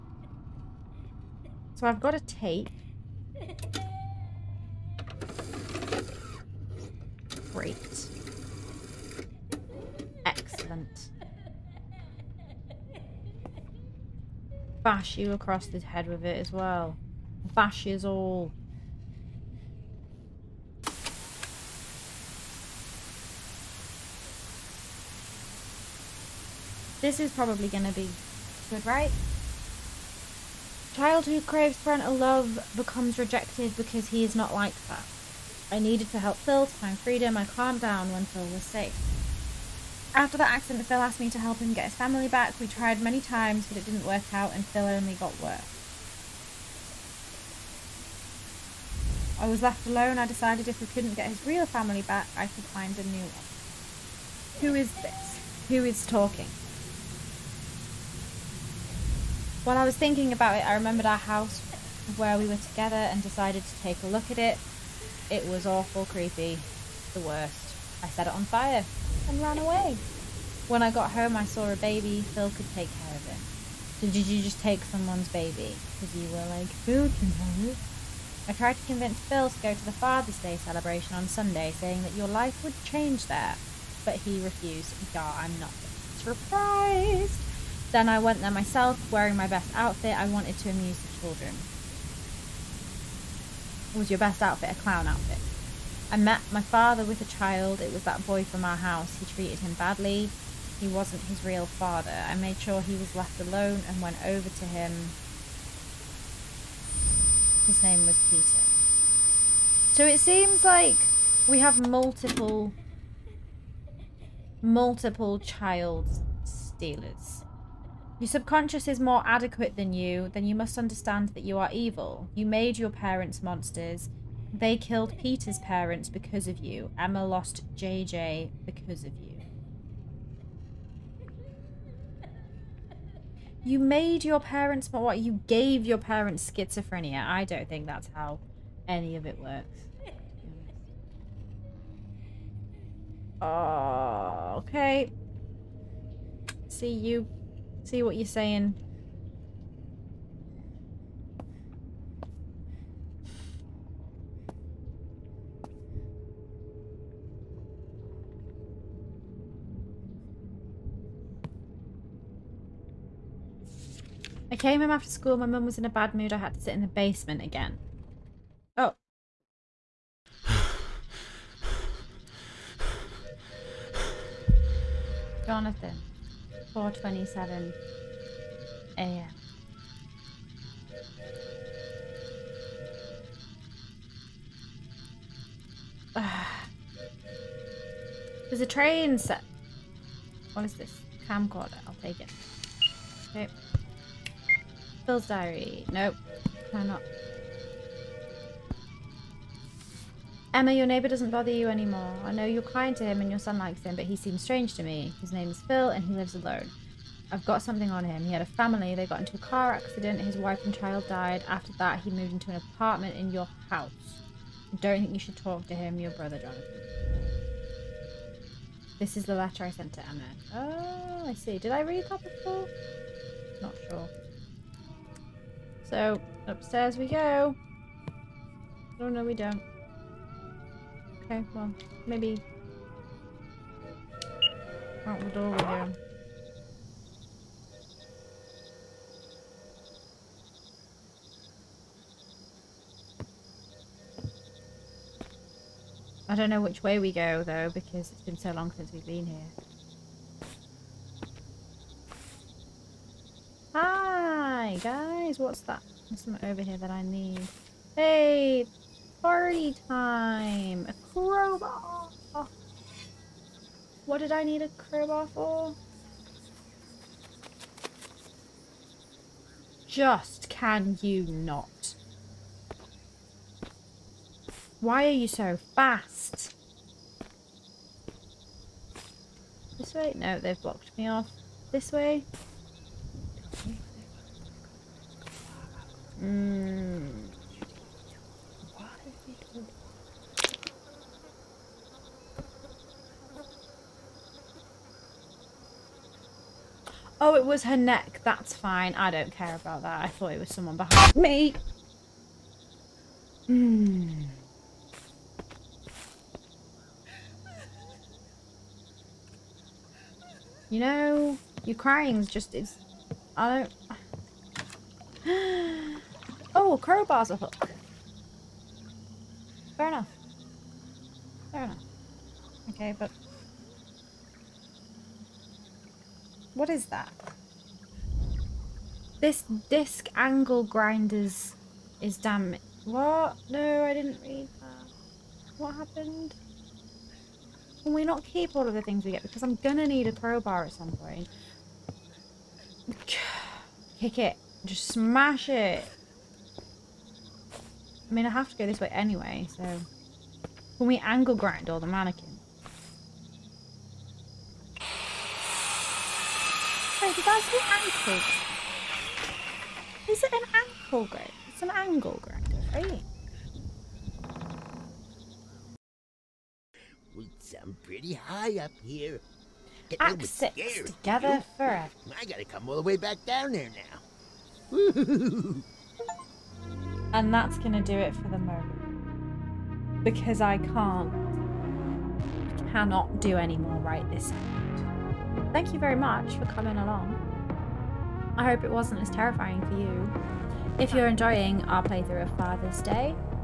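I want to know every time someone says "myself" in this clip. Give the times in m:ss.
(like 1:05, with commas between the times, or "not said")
1:28.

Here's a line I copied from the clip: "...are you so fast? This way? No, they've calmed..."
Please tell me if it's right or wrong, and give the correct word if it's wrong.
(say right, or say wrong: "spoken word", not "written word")
wrong: "blocked", not "calmed".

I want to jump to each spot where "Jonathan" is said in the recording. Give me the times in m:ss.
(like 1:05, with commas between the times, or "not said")
2:55, 3:36.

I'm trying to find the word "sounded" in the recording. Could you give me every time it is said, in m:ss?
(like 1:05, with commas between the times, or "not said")
not said.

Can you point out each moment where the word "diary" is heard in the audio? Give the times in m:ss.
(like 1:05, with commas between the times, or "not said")
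3:15.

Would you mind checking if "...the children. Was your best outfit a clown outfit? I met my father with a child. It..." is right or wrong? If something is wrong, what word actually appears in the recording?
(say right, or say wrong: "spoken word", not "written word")
right.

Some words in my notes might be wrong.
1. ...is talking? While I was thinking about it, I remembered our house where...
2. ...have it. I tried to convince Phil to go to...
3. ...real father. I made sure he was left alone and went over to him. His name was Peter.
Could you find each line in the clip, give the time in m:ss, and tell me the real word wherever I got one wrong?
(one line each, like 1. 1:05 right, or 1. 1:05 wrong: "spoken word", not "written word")
1. 0:55 right
2. 1:17 right
3. 1:41 right.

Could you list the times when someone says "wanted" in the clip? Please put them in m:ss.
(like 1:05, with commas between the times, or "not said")
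1:30.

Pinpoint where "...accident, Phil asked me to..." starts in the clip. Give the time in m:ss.
0:40.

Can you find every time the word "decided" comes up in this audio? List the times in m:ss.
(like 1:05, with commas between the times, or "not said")
0:50, 1:03.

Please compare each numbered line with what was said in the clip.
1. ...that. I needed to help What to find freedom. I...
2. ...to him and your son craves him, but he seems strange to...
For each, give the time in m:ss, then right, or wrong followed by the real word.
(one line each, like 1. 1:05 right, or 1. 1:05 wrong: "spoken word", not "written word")
1. 0:34 wrong: "Phil", not "What"
2. 3:22 wrong: "likes", not "craves".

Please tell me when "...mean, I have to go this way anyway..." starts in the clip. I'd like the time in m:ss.
5:48.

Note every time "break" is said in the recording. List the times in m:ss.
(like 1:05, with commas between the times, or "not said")
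not said.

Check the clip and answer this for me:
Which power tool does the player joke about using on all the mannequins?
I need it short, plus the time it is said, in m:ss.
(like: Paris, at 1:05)
An angle grinder, at 6:01.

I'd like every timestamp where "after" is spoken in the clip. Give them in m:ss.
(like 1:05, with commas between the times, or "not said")
0:40, 2:44, 3:31.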